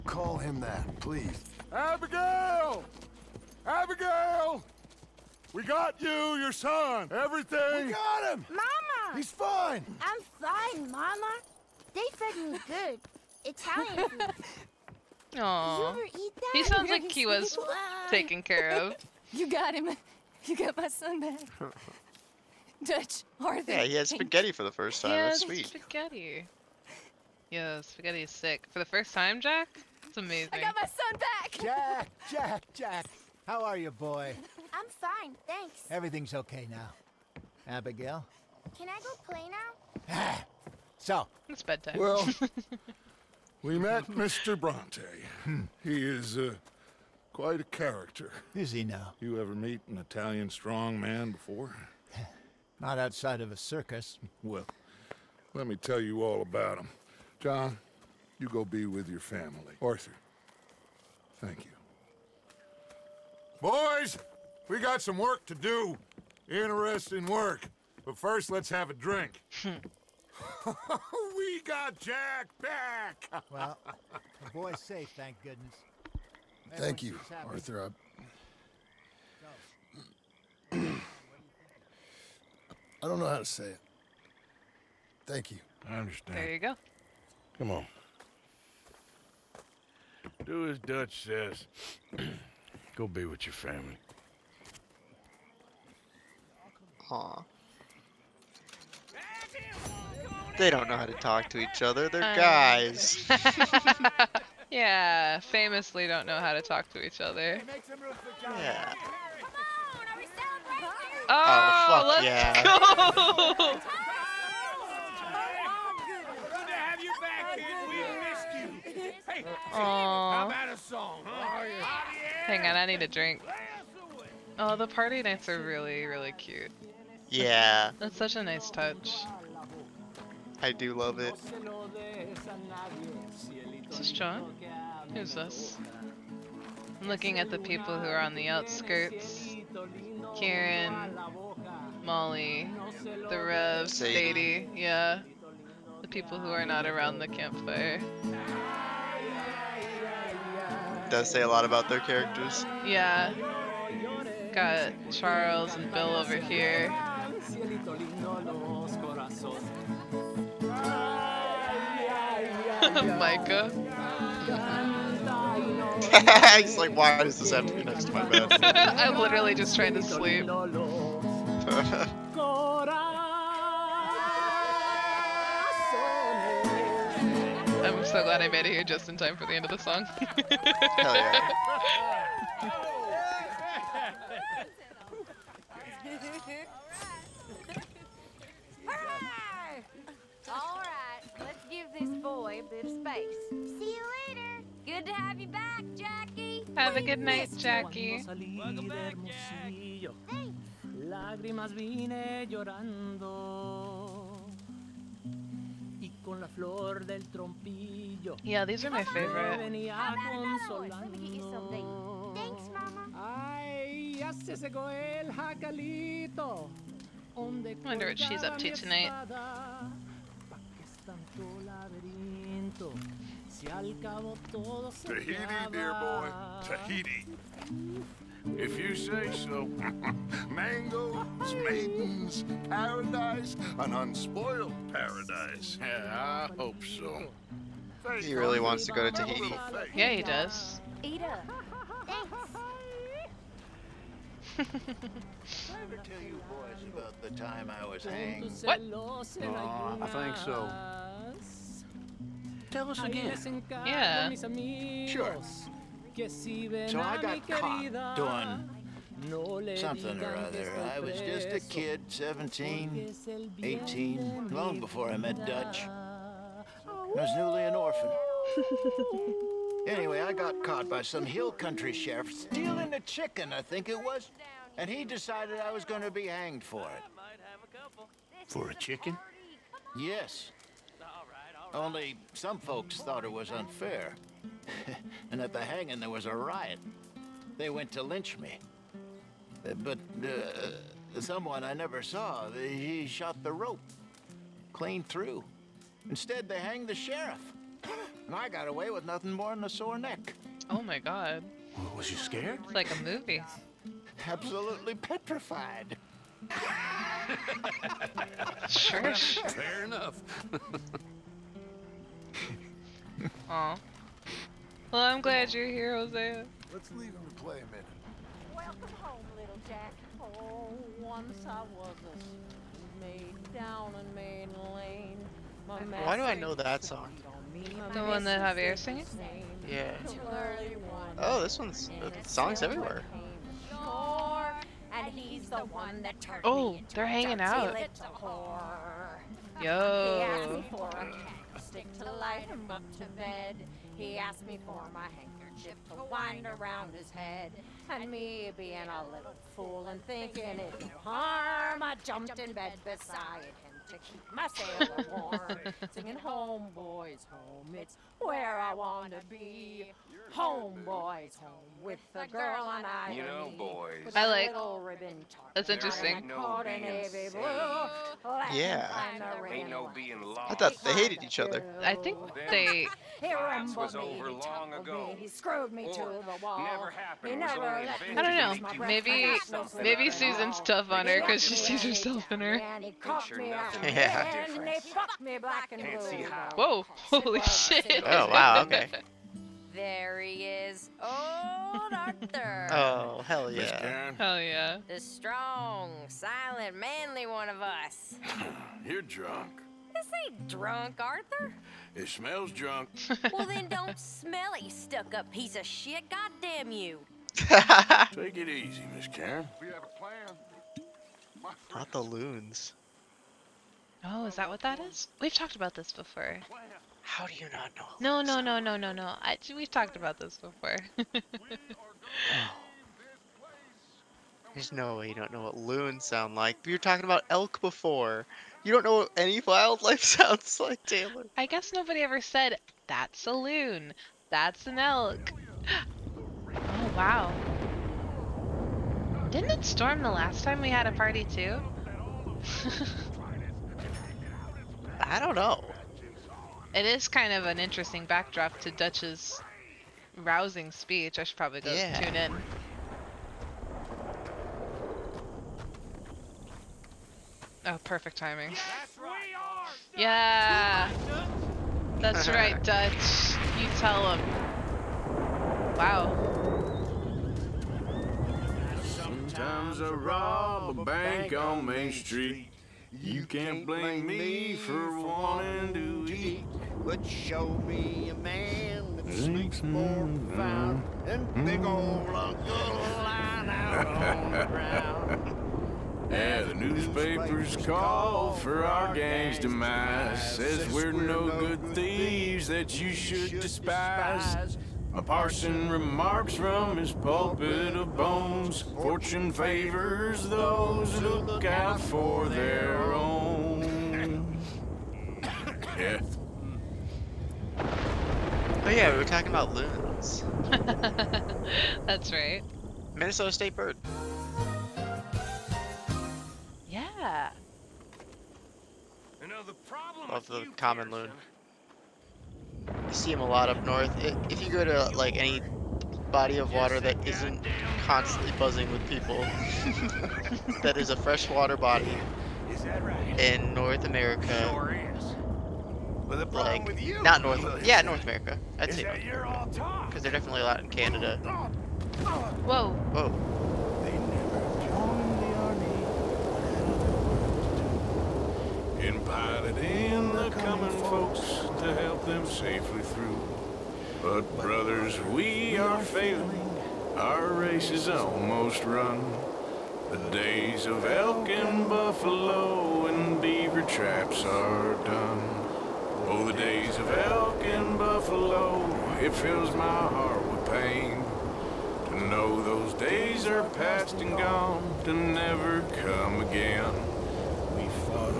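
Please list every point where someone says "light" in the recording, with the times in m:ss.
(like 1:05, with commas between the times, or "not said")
5:42.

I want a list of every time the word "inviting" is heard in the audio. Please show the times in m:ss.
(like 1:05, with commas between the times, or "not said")
not said.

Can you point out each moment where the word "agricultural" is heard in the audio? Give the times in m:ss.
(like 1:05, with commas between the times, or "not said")
not said.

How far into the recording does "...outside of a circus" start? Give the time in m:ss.
0:52.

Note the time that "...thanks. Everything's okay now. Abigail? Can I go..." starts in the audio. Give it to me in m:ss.
0:35.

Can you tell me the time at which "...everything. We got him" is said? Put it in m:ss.
0:07.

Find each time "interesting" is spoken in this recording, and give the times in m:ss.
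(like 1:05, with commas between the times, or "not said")
1:06, 6:05, 7:27.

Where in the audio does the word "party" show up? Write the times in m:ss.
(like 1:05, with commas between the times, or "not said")
2:04, 7:20.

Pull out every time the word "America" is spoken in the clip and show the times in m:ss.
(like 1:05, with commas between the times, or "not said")
8:53, 8:58.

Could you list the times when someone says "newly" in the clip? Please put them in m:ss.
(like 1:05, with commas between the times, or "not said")
4:27.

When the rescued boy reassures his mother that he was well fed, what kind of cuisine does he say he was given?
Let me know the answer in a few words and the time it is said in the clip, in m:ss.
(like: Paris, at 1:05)
Italian food, at 0:13.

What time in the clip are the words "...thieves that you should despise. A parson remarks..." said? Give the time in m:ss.
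8:11.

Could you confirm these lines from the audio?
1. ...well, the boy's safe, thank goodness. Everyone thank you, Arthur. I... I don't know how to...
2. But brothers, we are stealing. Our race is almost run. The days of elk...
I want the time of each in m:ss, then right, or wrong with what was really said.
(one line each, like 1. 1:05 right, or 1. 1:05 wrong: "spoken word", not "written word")
1. 1:13 right
2. 9:14 wrong: "failing", not "stealing".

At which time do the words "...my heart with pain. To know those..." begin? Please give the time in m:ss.
9:29.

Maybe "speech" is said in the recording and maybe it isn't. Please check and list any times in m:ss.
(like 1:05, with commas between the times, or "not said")
7:30.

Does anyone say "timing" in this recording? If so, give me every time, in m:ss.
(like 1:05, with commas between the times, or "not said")
7:38.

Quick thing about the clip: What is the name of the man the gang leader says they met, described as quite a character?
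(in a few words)
Mr. Bronte.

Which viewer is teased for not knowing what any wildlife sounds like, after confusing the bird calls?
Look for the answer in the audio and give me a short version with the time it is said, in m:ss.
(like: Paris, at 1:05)
Taylor, at 7:10.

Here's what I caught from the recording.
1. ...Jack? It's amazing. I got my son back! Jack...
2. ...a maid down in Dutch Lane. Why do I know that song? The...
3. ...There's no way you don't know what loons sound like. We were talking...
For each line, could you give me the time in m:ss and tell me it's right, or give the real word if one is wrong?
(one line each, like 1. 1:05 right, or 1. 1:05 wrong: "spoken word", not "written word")
1. 0:29 right
2. 5:22 wrong: "Main", not "Dutch"
3. 7:04 right.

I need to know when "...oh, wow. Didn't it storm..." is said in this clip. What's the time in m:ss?
7:16.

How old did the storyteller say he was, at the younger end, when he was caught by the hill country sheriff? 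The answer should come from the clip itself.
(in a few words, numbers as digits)
17.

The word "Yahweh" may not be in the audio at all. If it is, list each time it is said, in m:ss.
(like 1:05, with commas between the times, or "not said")
not said.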